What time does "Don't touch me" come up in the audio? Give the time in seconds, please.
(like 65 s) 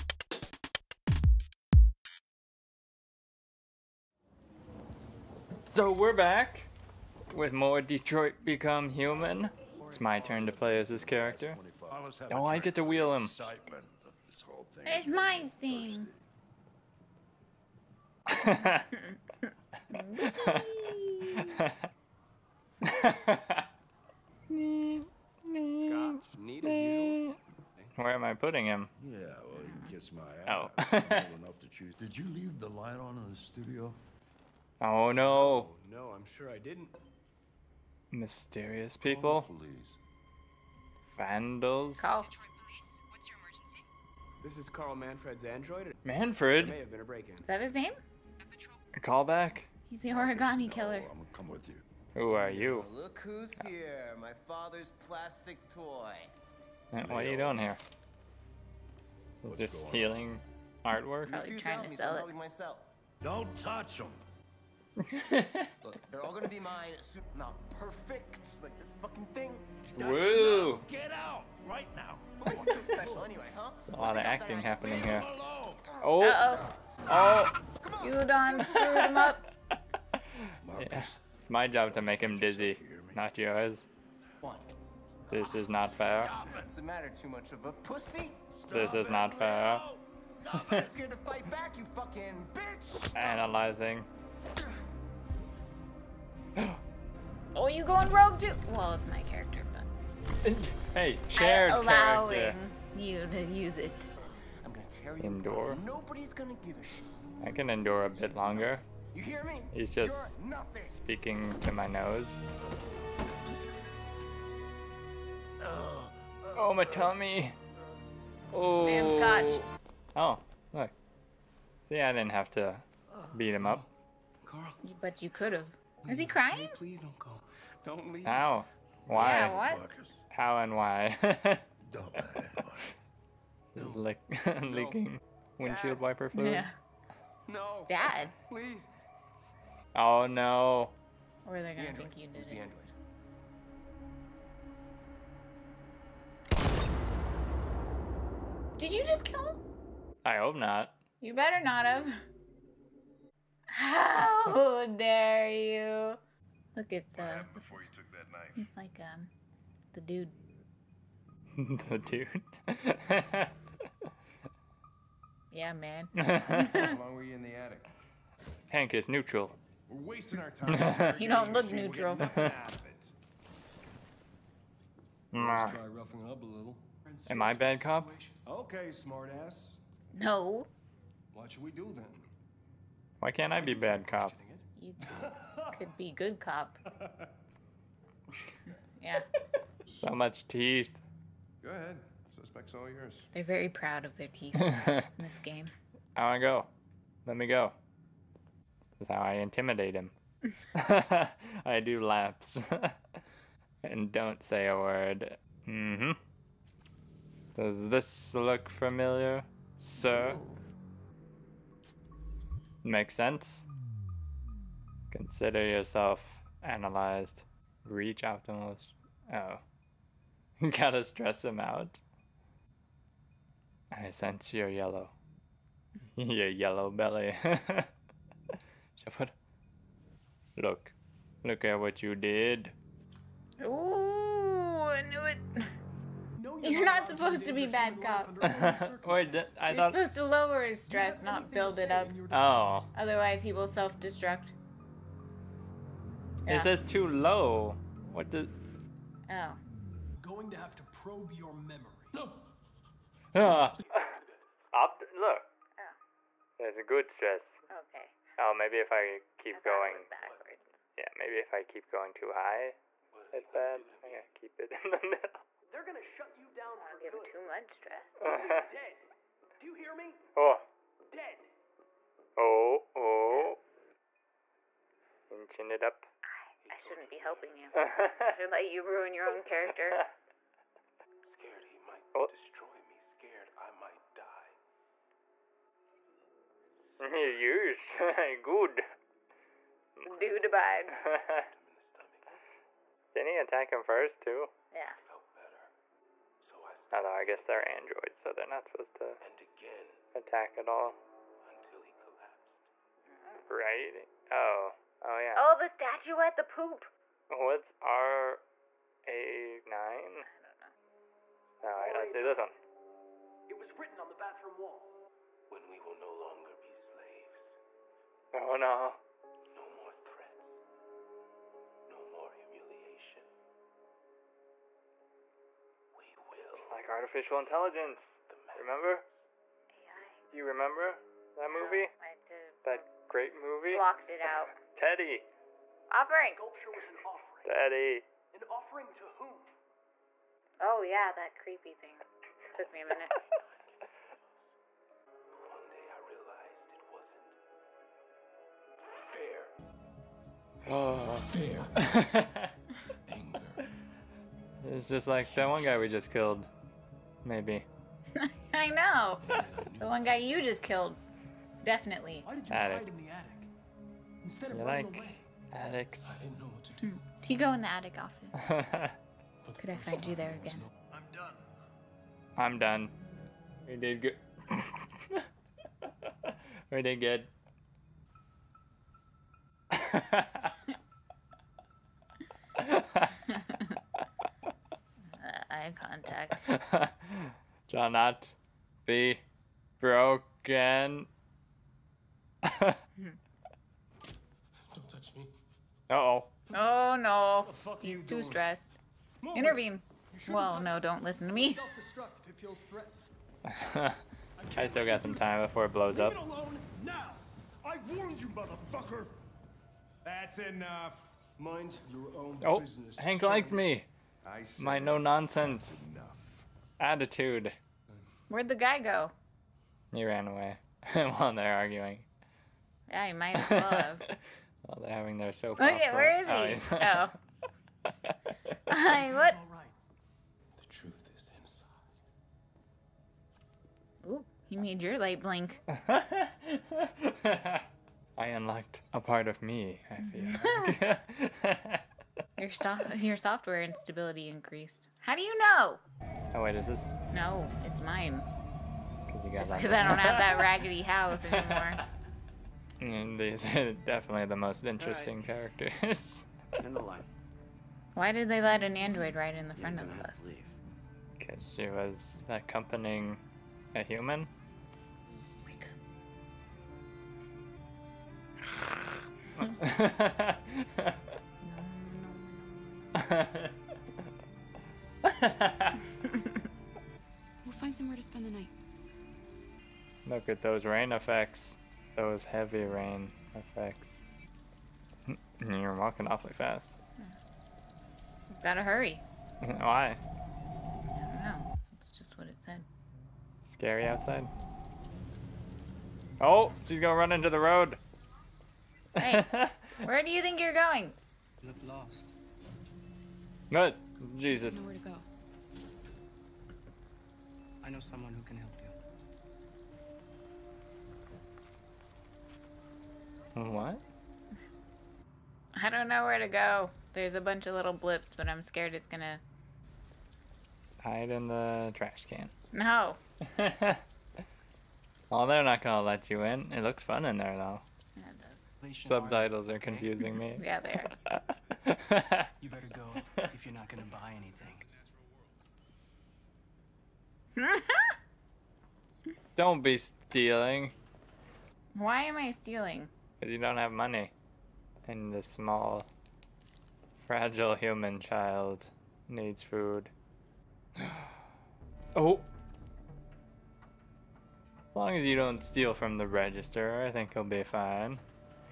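394 s.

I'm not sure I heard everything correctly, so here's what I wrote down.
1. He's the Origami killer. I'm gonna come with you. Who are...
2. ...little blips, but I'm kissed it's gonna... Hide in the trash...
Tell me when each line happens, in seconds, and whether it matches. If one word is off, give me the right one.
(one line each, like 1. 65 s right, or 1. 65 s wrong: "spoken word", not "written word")
1. 49 s right
2. 517 s wrong: "scared", not "kissed".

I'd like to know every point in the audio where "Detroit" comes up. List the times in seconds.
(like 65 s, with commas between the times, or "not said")
7 s, 42 s.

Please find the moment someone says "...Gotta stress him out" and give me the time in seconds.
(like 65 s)
220 s.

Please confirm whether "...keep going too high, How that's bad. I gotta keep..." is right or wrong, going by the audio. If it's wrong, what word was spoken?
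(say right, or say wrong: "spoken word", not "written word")
wrong: "What", not "How".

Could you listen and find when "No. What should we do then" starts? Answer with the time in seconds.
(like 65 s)
180 s.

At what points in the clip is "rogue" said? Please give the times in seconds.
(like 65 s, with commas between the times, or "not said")
98 s.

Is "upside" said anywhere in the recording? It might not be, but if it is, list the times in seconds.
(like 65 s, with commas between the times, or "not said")
not said.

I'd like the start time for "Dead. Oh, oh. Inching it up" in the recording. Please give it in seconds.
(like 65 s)
271 s.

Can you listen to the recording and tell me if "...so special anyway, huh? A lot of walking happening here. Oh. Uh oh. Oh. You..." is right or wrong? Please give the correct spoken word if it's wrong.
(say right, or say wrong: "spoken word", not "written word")
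wrong: "acting", not "walking".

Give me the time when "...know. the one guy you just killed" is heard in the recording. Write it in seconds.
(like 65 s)
358 s.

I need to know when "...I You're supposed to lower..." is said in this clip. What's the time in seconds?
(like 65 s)
239 s.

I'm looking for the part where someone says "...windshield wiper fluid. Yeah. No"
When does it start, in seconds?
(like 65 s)
135 s.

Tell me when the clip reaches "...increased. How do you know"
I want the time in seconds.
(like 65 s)
444 s.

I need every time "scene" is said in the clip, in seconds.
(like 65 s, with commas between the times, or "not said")
15 s.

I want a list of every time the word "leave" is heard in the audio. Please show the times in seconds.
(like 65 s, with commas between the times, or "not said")
32 s, 128 s, 405 s.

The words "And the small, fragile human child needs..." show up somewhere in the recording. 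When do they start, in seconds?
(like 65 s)
544 s.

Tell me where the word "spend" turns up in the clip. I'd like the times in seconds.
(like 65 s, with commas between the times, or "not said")
478 s.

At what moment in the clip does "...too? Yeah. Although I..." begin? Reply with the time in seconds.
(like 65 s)
294 s.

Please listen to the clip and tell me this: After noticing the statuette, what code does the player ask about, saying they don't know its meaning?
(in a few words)
RA9.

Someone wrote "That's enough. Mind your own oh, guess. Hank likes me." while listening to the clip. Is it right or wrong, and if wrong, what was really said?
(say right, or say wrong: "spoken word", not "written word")
wrong: "business", not "guess".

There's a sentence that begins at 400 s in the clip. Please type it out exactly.
Well, no, don't listen to me.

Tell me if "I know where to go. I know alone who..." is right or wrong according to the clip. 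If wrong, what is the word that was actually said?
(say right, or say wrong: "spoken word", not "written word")
wrong: "someone", not "alone".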